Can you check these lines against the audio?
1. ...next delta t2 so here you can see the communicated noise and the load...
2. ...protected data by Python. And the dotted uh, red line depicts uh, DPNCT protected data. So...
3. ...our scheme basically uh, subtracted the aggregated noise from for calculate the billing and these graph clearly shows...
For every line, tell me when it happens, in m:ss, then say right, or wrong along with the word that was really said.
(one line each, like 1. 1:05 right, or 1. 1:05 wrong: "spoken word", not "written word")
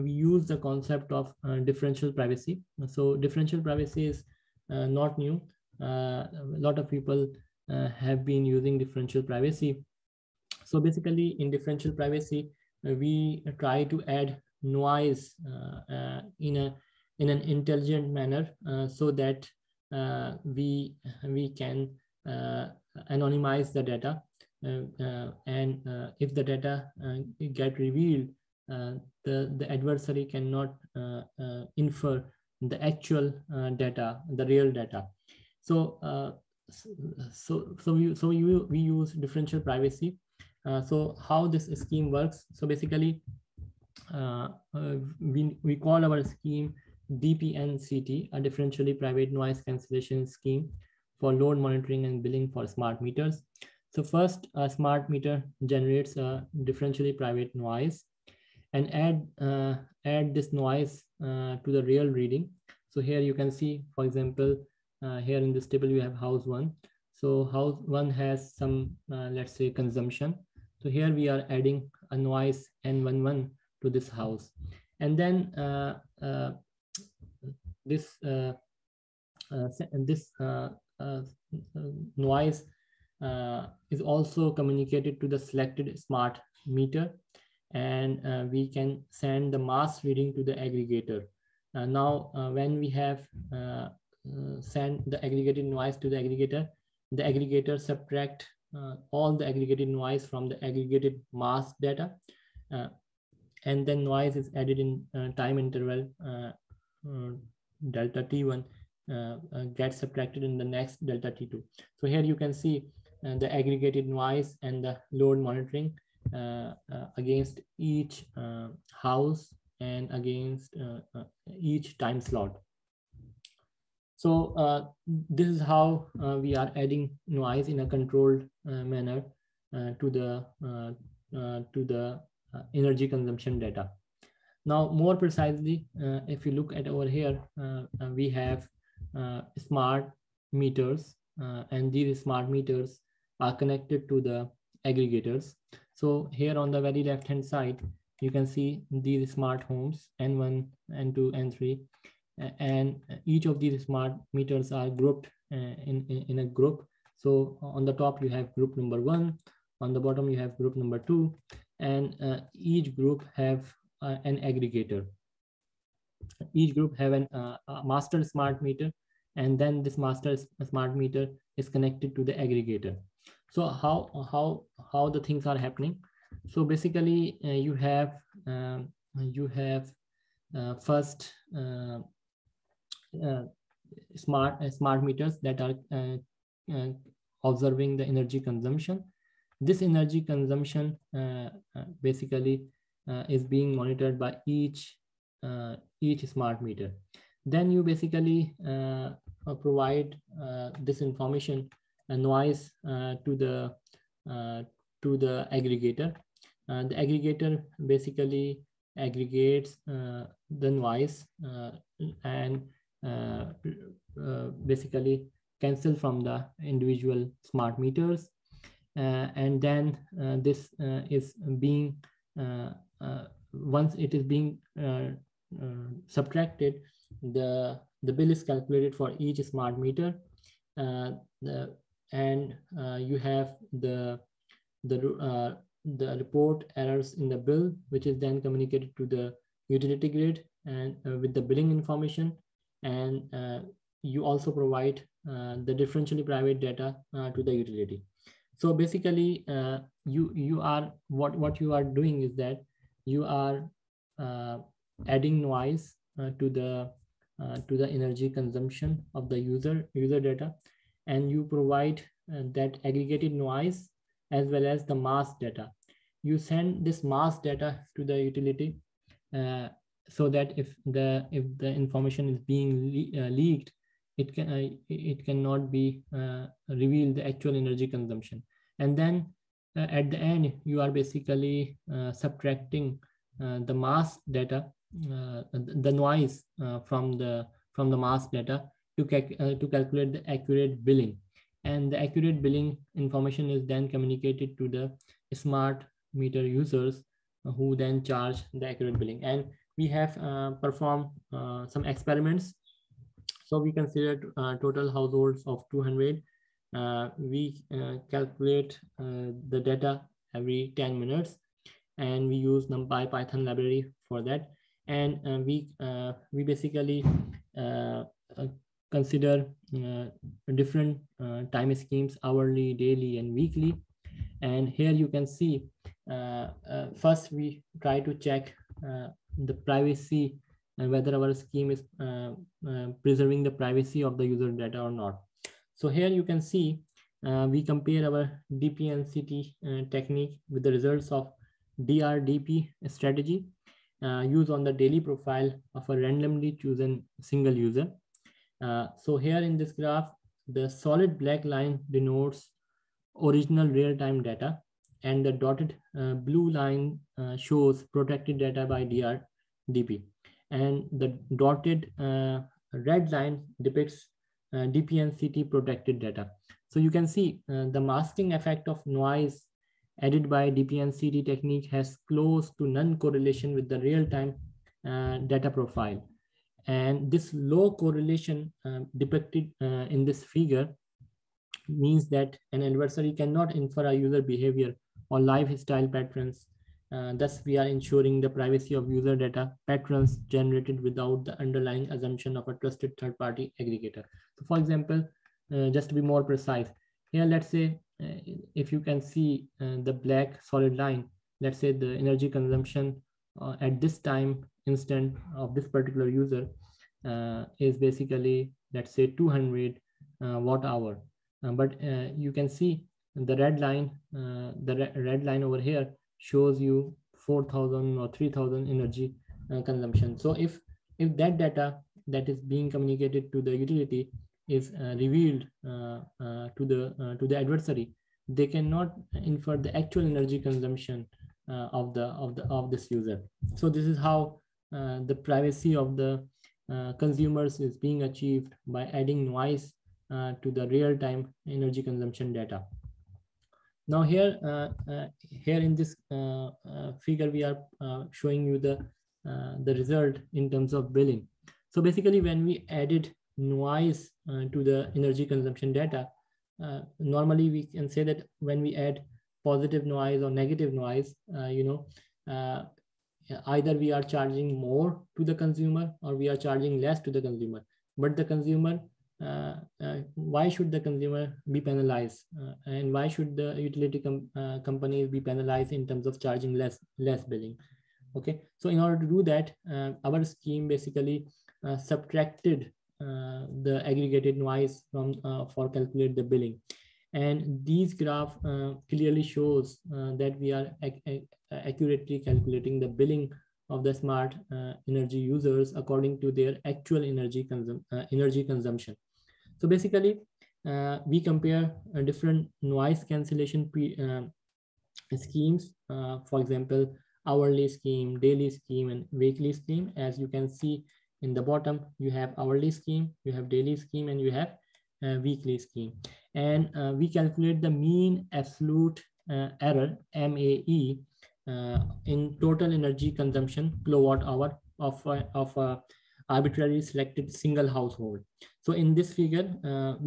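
1. 1:50 wrong: "aggregated", not "communicated"
2. 5:57 wrong: "DRDP", not "Python"
3. 8:00 right.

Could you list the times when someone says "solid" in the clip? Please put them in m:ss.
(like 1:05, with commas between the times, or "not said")
5:50, 6:40.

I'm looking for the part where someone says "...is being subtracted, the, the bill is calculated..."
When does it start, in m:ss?
3:44.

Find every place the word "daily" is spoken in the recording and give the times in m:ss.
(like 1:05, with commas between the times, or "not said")
5:22, 5:44, 8:28, 8:33.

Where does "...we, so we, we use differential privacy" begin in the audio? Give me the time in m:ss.
0:37.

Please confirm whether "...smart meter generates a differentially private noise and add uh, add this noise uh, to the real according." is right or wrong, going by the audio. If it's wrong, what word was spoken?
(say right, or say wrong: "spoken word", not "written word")
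wrong: "reading", not "according".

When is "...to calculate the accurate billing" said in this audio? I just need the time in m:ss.
4:49.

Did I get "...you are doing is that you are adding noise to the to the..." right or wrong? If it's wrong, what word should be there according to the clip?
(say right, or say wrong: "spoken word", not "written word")
right.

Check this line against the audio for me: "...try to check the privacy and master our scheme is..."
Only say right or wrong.
wrong.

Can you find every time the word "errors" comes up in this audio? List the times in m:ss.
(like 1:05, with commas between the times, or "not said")
3:56, 8:39.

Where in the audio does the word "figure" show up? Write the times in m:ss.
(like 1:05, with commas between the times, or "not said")
6:20, 7:27, 8:49.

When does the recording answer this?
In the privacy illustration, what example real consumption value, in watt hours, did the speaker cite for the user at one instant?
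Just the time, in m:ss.
6:49.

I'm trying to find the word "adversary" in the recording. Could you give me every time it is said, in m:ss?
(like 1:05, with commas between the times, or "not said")
0:29, 6:22, 7:07.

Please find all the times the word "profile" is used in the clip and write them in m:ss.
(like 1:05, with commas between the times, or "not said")
5:45, 6:15.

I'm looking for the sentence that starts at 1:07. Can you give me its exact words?
So house one has some, uh, let's say consumption.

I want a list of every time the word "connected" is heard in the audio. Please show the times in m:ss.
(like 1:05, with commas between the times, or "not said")
2:23, 2:51.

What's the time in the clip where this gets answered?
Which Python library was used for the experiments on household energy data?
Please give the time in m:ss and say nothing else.
5:12.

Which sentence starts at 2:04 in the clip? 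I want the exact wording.
So uh, this is how uh, we are adding noise in a controlled uh, manner to the to the energy consumption data.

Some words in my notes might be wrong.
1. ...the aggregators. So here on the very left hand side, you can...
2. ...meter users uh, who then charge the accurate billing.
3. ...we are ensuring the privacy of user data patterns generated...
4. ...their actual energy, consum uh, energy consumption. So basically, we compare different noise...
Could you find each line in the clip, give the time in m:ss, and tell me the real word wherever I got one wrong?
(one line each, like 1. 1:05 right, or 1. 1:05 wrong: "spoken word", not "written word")
1. 2:24 right
2. 4:56 right
3. 6:27 right
4. 8:16 right.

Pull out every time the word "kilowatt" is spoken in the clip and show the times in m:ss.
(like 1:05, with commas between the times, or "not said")
8:43.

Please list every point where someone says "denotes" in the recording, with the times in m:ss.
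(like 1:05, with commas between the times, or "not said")
5:51.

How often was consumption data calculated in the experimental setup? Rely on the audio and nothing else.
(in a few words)
every 10 minutes.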